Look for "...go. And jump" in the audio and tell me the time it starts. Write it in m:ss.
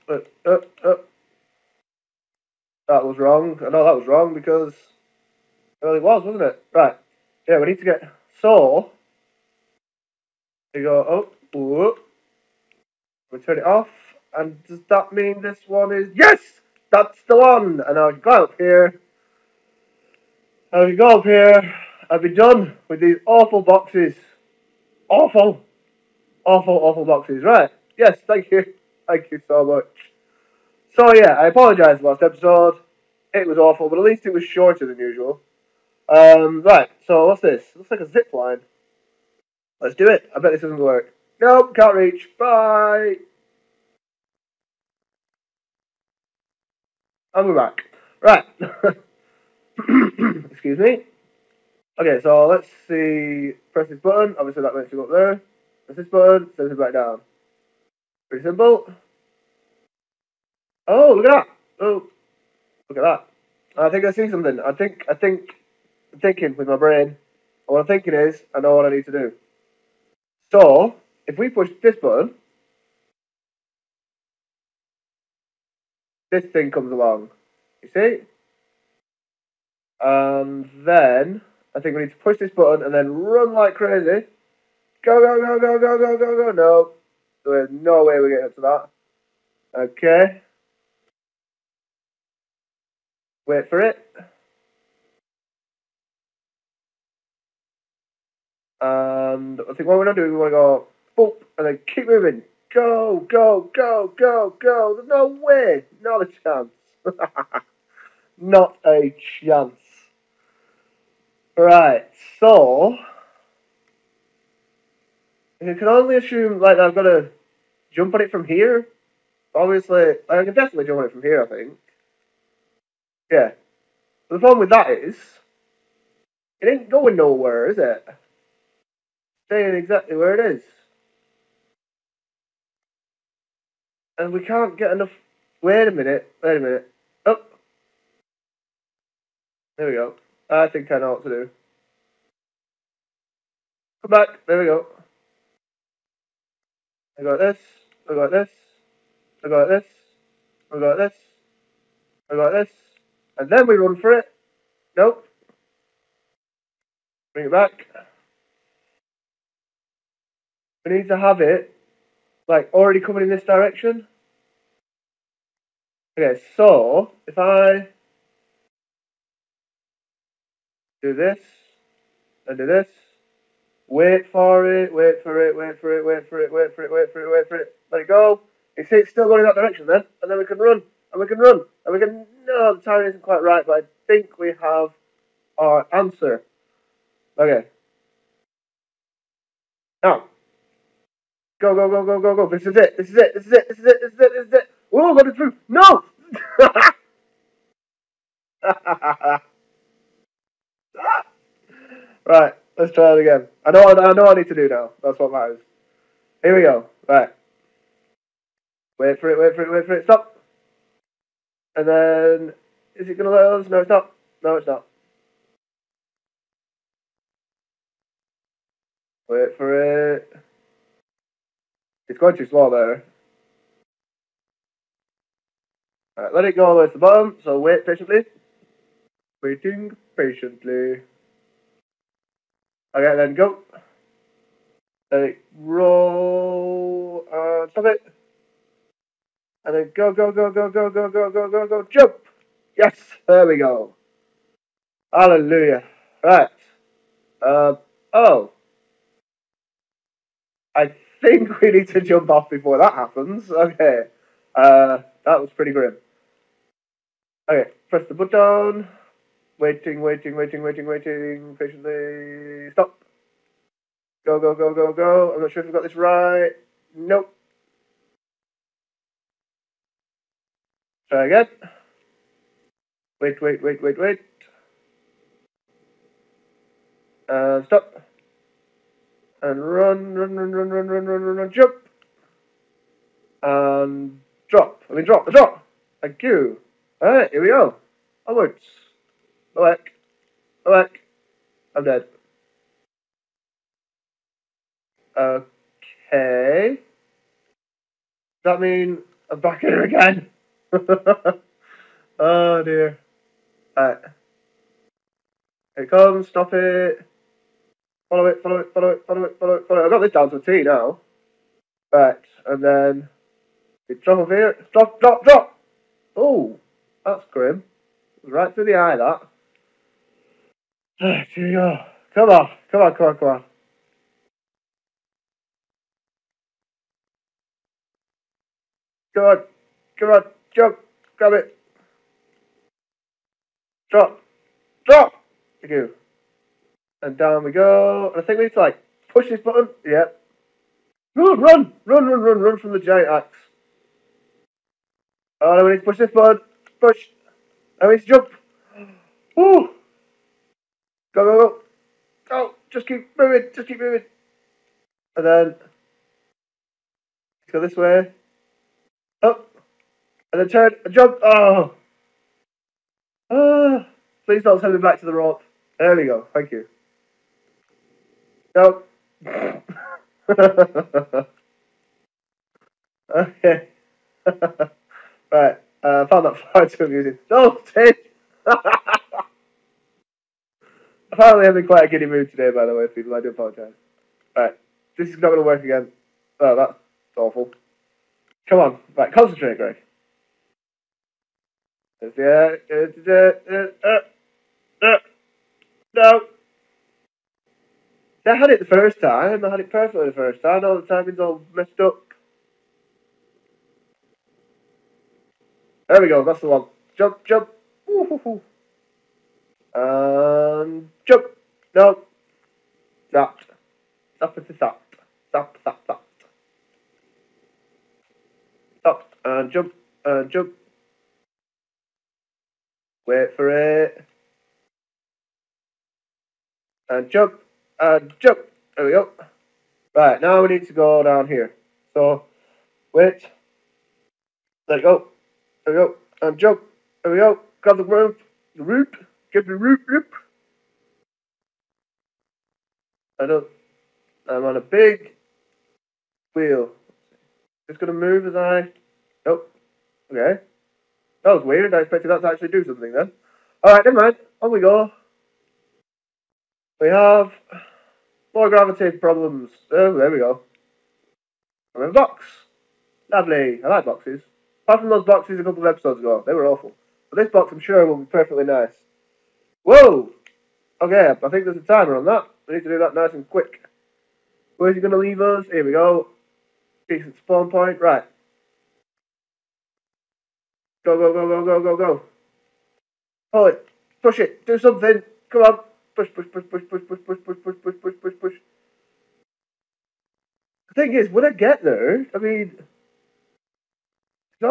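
7:15.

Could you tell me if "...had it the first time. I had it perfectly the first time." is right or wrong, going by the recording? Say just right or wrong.
right.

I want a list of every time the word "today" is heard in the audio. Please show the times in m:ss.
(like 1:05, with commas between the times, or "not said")
6:22.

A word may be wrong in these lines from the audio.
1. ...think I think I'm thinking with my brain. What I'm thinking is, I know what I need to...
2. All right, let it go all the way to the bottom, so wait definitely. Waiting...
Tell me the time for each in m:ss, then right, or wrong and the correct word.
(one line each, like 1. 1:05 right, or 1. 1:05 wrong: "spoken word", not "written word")
1. 1:04 right
2. 3:46 wrong: "patiently", not "definitely".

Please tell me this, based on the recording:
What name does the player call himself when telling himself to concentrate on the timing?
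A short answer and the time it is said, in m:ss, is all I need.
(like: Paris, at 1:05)
Greg, at 6:29.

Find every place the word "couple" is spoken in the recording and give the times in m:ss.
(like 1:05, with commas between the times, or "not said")
7:45.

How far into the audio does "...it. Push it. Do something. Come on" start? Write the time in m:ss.
8:03.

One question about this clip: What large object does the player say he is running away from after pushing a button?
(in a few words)
Giant axe.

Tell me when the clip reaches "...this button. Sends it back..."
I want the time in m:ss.
0:55.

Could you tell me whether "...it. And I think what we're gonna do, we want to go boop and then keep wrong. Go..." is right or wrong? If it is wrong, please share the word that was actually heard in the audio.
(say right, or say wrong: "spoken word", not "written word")
wrong: "moving", not "wrong".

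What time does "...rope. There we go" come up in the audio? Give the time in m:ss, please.
6:05.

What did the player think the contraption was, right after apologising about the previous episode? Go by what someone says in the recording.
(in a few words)
A zip line.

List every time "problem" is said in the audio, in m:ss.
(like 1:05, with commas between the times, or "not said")
2:04, 7:38.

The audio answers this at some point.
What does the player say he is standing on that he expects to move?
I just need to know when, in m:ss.
7:24.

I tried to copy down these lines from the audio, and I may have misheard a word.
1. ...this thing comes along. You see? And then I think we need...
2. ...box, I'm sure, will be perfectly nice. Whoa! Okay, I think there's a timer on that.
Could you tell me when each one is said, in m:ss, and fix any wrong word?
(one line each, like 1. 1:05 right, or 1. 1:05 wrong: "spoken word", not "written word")
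1. 1:16 right
2. 7:47 right.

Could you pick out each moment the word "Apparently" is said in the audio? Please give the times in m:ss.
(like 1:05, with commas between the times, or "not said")
6:21.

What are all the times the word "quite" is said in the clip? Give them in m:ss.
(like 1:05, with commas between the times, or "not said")
3:03, 6:21.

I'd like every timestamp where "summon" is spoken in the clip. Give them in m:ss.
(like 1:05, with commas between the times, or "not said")
not said.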